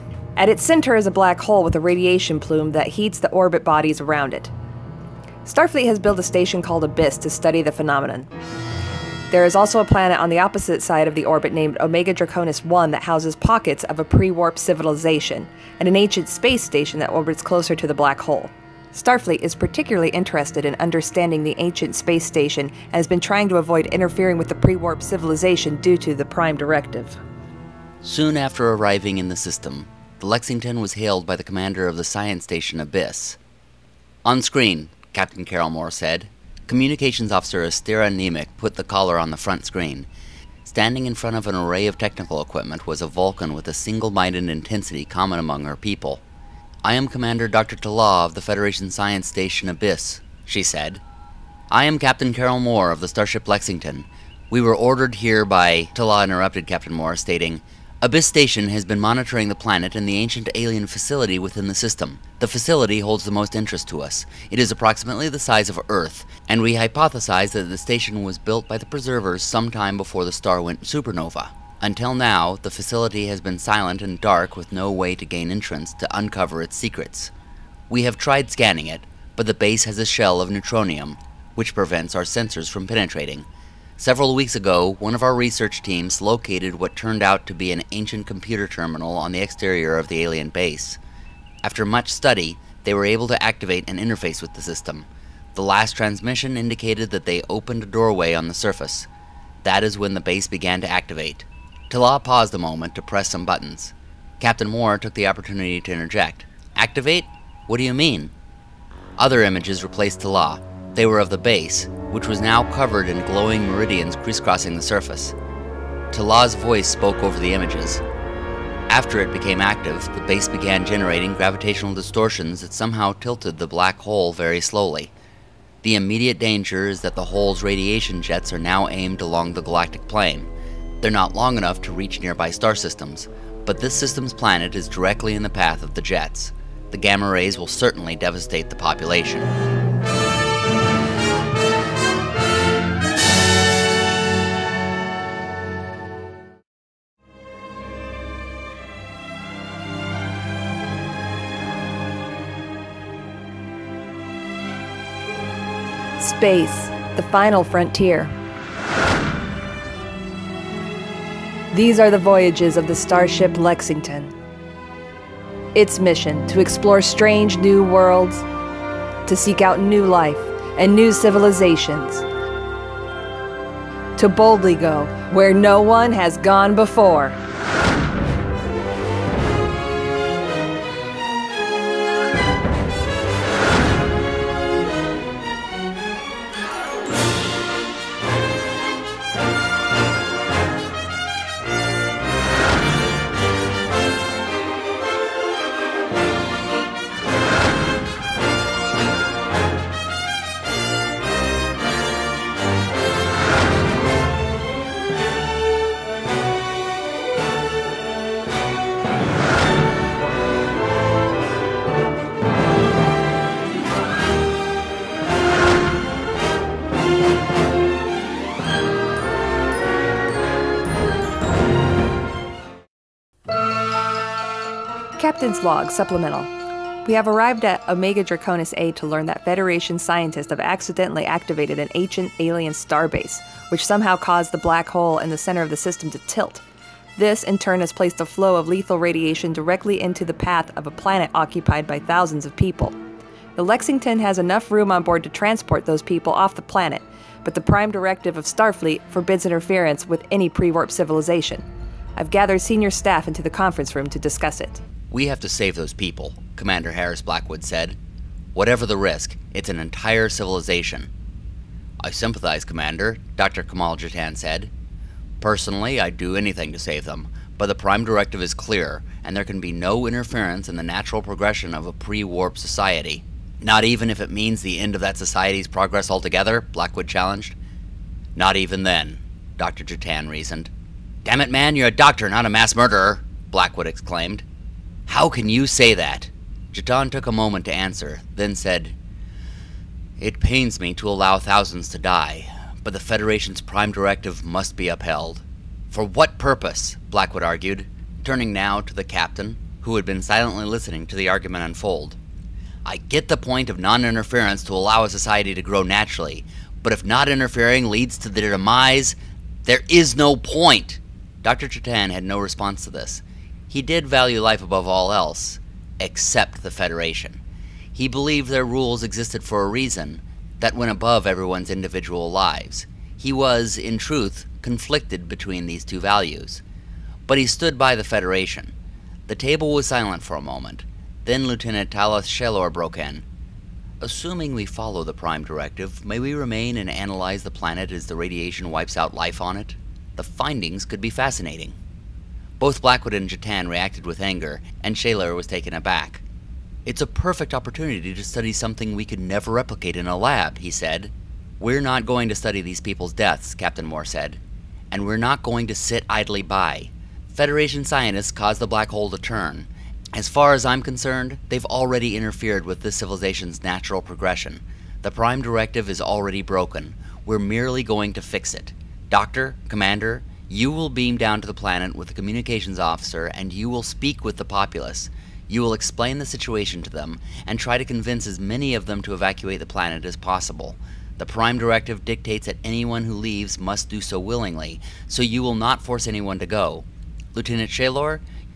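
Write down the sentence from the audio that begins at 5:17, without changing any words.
He believed their rules existed for a reason that went above everyone's individual lives.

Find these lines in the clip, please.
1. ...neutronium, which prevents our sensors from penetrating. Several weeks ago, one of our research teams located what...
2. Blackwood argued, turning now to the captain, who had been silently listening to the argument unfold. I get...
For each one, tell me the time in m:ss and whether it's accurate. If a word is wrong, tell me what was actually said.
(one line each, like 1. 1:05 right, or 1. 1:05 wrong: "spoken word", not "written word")
1. 1:20 right
2. 4:57 right.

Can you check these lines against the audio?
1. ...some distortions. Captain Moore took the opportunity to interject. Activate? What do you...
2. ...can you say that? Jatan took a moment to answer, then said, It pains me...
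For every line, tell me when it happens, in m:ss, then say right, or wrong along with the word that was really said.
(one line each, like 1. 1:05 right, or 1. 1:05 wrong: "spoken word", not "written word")
1. 1:43 wrong: "buttons", not "distortions"
2. 4:45 right.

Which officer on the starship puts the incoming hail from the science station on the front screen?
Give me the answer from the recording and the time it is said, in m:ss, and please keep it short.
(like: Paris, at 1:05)
Astera Nemec, at 0:37.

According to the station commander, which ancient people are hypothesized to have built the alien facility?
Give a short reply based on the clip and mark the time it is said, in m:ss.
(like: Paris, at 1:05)
The Preservers, at 1:08.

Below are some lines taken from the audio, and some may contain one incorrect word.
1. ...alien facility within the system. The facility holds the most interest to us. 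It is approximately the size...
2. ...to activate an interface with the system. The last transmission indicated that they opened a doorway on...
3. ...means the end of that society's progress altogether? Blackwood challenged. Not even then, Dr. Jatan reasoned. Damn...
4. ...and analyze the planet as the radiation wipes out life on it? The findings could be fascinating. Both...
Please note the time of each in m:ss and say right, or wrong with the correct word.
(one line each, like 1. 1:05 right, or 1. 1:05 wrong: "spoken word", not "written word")
1. 1:00 right
2. 1:33 right
3. 4:34 right
4. 5:36 right.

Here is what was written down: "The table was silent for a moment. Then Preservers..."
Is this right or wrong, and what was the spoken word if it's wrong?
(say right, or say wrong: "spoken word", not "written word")
wrong: "Lieutenant", not "Preservers".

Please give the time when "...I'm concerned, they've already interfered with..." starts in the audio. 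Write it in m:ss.
6:00.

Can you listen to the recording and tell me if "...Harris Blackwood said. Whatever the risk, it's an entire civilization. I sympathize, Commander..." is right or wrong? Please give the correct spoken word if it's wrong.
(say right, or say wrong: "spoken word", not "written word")
right.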